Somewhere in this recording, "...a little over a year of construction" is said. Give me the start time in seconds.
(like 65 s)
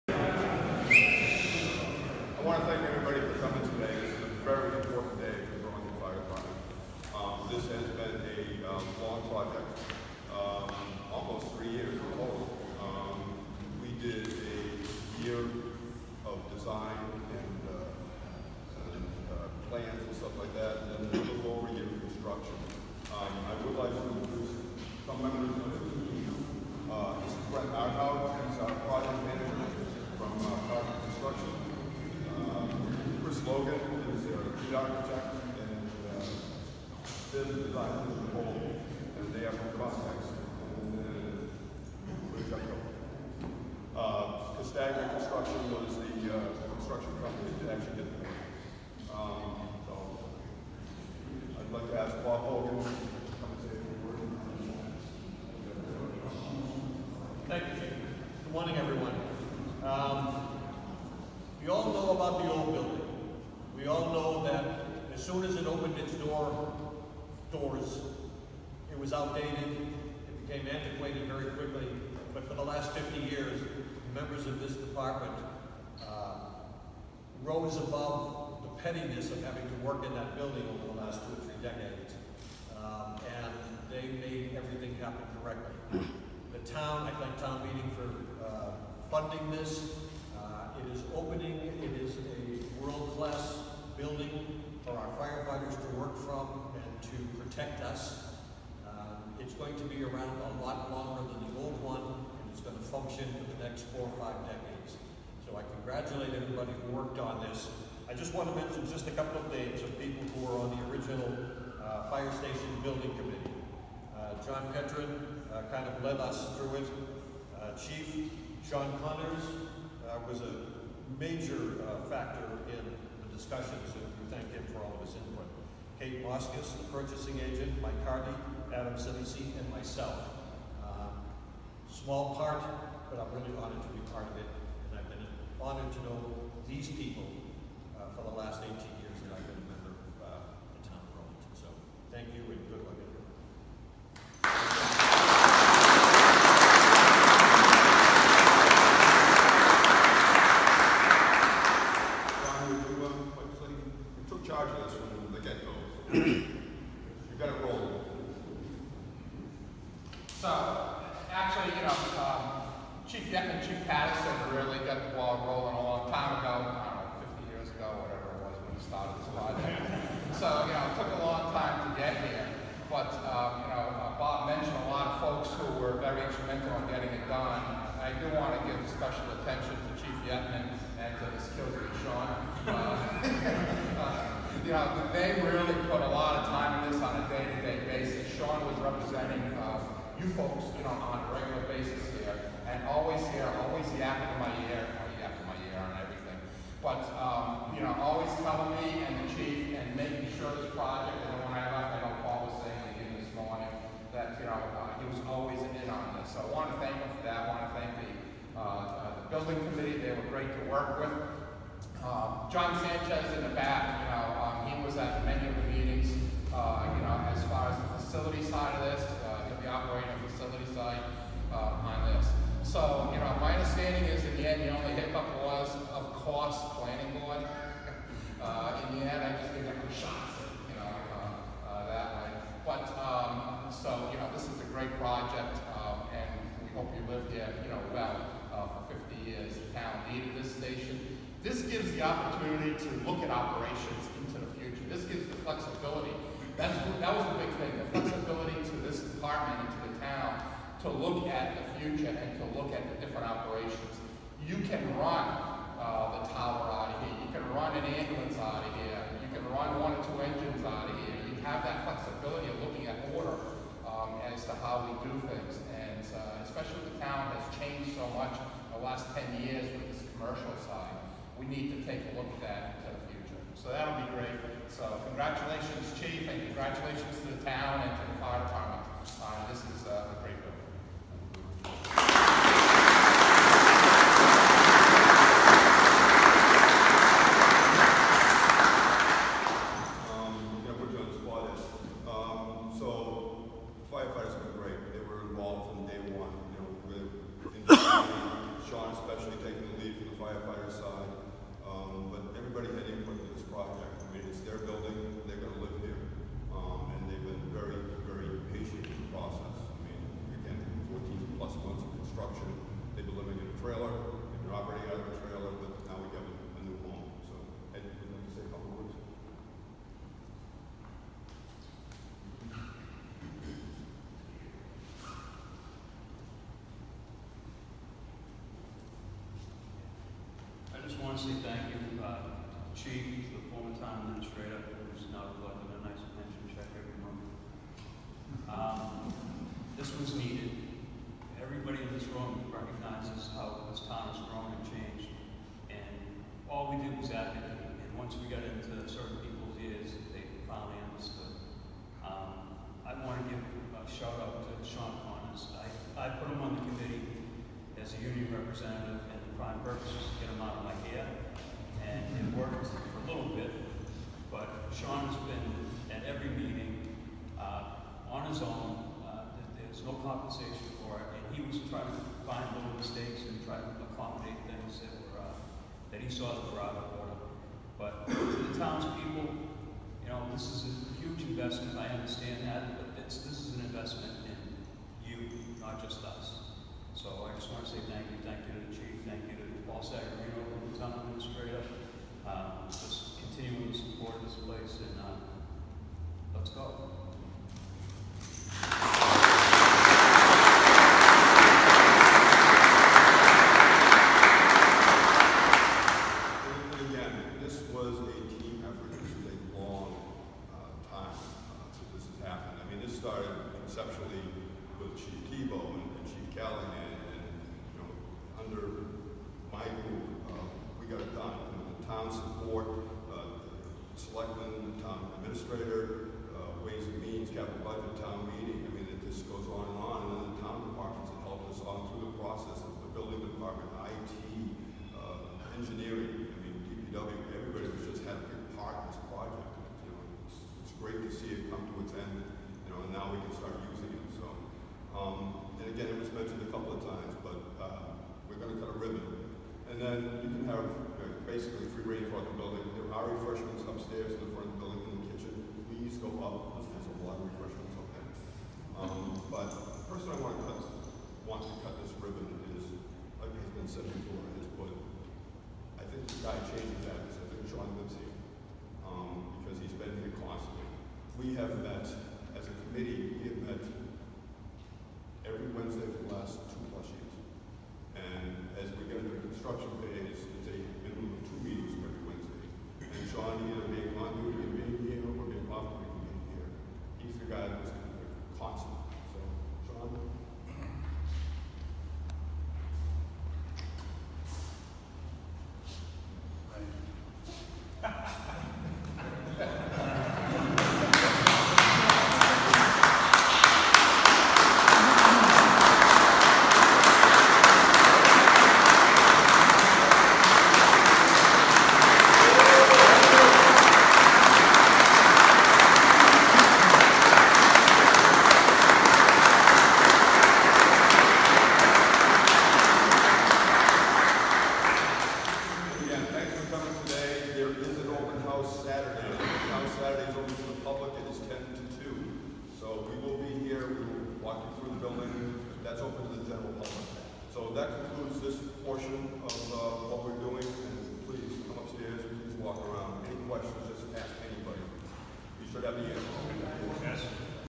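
21 s.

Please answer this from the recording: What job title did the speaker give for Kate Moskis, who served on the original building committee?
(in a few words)
purchasing agent.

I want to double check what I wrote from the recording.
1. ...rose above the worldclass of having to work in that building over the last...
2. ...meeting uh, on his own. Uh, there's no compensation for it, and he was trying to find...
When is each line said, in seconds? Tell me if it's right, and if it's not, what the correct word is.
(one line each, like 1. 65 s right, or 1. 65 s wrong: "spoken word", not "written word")
1. 77 s wrong: "pettiness", not "worldclass"
2. 366 s right.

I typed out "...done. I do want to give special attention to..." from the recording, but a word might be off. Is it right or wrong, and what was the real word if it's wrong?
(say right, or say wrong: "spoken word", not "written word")
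right.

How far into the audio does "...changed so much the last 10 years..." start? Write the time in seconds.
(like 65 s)
267 s.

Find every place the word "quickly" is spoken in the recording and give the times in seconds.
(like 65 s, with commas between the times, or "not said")
71 s.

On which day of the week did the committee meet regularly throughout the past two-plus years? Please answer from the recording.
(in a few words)
Wednesday.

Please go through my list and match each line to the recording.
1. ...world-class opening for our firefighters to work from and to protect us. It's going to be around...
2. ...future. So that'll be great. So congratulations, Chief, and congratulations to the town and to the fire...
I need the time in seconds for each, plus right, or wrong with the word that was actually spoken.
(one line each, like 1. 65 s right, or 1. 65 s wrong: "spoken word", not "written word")
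1. 92 s wrong: "building", not "opening"
2. 273 s right.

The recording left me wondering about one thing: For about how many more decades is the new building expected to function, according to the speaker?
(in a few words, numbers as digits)
4 or 5 decades.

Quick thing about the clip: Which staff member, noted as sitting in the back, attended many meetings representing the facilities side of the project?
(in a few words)
John Sanchez.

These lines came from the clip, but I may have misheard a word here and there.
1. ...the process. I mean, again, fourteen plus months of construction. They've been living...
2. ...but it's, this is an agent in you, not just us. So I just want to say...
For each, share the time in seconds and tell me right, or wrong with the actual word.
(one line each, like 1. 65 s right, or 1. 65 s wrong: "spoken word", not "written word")
1. 308 s right
2. 382 s wrong: "investment", not "agent".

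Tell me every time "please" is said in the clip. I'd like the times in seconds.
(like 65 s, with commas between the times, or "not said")
455 s, 541 s.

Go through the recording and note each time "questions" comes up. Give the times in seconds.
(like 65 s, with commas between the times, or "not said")
543 s.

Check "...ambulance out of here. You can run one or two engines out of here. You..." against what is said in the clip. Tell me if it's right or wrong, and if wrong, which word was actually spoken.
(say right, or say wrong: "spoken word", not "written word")
right.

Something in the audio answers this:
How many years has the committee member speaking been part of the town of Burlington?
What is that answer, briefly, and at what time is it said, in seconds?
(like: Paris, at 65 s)
18 years, at 138 s.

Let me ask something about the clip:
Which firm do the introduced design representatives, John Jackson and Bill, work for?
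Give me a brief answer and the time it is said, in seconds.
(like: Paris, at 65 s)
Context, at 39 s.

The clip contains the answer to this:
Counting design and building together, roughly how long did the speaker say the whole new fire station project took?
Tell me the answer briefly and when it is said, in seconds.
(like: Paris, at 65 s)
almost three years, at 11 s.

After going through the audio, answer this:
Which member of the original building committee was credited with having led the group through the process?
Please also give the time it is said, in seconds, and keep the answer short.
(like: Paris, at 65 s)
John Petrin, at 114 s.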